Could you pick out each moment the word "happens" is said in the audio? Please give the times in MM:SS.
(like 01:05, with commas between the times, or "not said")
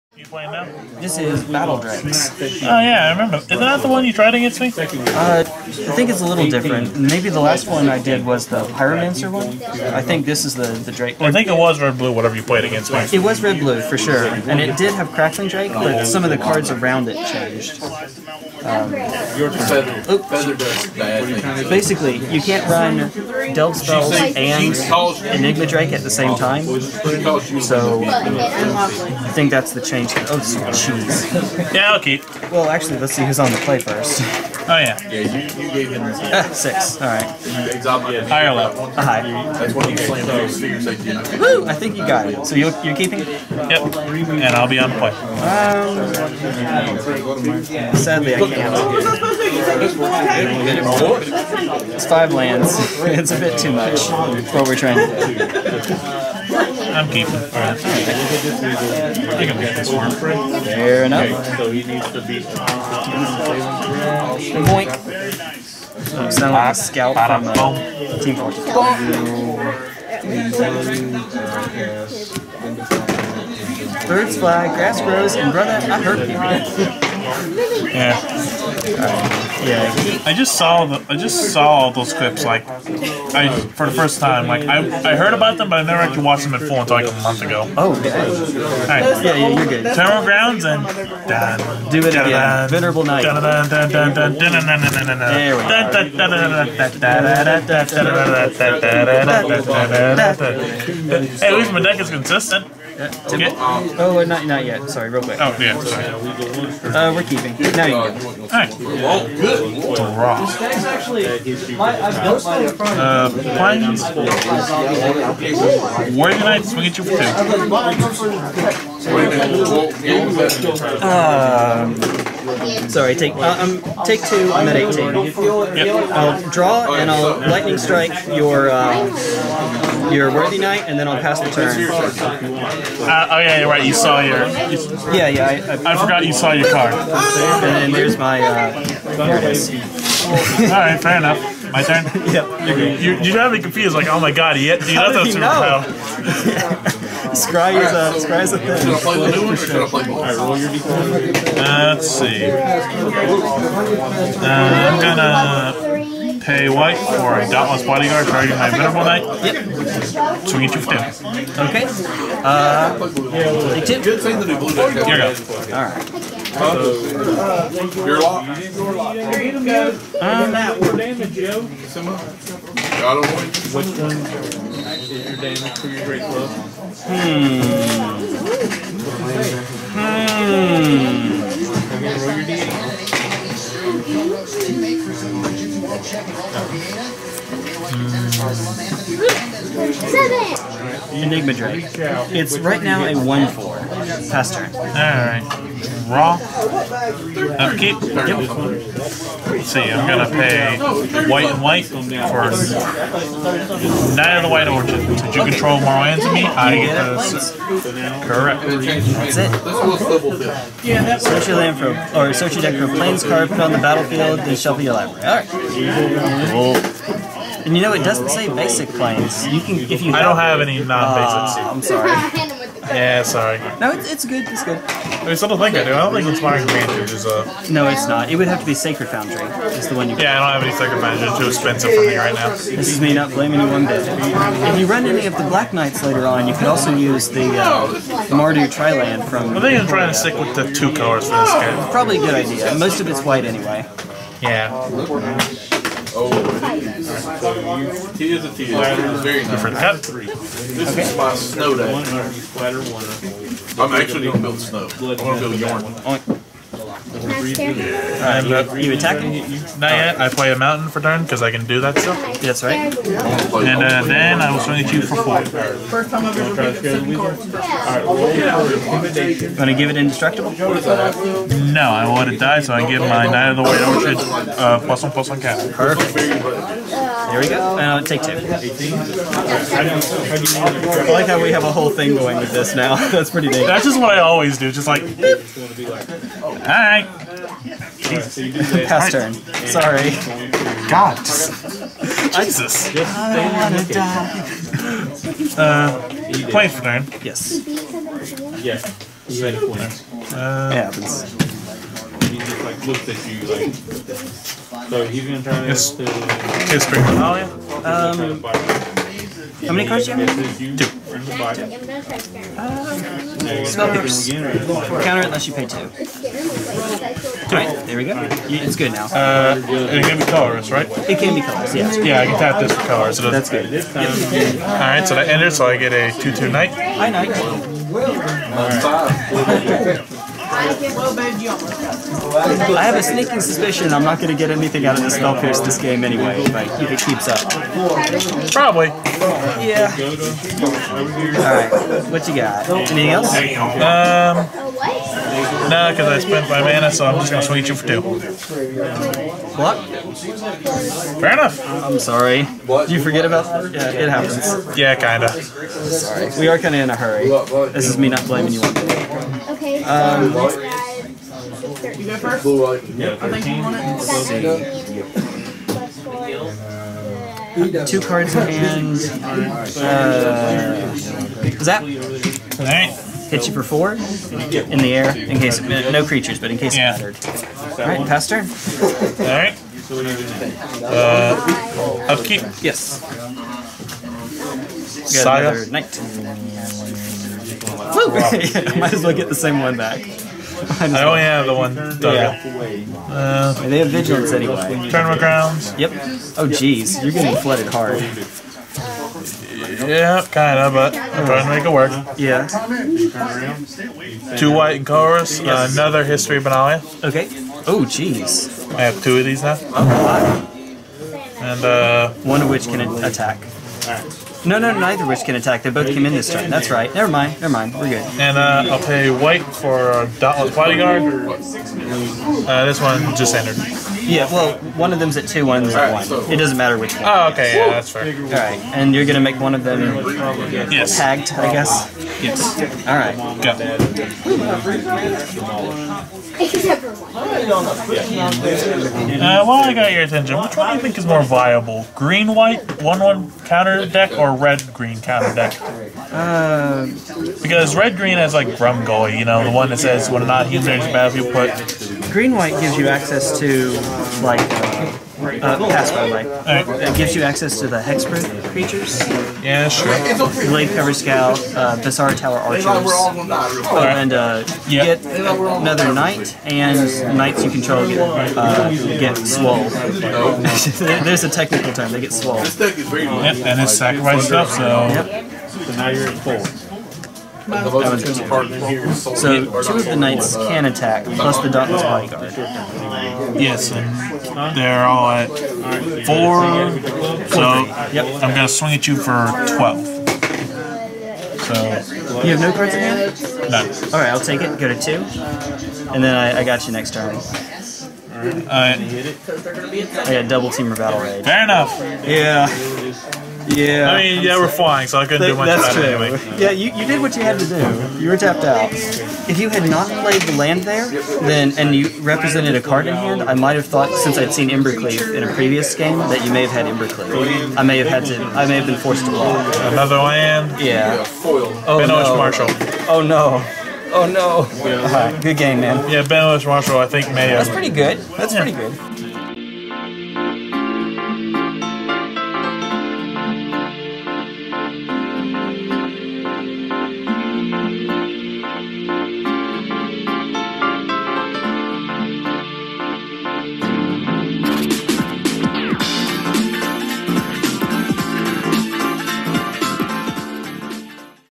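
05:00, 05:54.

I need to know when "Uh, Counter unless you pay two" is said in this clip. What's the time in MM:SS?
05:12.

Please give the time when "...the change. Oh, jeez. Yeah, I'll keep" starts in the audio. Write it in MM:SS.
00:29.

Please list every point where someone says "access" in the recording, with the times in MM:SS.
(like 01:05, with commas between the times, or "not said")
07:32, 07:37.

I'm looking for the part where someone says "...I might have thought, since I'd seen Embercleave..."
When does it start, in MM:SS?
08:33.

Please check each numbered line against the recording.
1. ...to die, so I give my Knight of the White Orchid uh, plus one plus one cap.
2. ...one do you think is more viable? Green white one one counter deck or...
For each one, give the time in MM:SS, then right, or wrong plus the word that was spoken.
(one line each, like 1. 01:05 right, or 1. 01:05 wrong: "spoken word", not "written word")
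1. 04:32 right
2. 07:20 right.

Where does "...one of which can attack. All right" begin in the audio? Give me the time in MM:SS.
06:52.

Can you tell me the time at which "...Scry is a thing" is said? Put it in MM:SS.
02:28.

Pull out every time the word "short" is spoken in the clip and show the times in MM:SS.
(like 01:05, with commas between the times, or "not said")
not said.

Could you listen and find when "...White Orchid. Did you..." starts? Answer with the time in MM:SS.
03:24.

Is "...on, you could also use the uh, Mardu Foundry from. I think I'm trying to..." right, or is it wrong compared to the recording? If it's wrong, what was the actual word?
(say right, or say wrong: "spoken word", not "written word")
wrong: "Triland", not "Foundry".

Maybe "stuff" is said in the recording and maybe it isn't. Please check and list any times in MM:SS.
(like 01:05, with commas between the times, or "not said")
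04:21, 07:54.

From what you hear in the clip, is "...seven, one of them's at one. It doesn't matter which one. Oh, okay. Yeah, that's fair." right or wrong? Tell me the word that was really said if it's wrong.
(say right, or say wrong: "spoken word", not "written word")
wrong: "two", not "seven".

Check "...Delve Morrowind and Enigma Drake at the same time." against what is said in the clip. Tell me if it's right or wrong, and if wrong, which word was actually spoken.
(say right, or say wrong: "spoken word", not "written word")
wrong: "Spells", not "Morrowind".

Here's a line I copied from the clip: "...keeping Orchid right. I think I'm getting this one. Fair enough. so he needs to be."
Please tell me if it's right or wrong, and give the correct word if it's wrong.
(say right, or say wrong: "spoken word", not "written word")
wrong: "All", not "Orchid".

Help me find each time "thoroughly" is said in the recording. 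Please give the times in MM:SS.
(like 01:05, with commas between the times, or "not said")
not said.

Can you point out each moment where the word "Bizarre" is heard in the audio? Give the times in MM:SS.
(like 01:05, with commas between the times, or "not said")
07:41.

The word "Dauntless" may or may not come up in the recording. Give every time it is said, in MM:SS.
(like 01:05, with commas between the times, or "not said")
02:37, 07:00, 08:01.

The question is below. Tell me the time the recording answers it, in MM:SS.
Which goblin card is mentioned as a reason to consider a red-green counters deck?
07:28.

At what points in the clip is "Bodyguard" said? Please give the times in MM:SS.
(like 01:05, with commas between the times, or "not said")
02:37, 07:00, 08:01.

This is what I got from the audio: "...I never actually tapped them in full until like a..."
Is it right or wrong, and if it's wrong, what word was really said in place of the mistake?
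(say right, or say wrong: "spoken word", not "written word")
wrong: "watched", not "tapped".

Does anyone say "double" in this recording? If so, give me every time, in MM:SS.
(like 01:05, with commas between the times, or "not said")
08:20.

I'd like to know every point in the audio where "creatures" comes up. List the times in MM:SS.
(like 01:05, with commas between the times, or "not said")
06:16, 07:38.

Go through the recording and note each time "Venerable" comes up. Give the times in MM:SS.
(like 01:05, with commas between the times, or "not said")
01:32, 02:38.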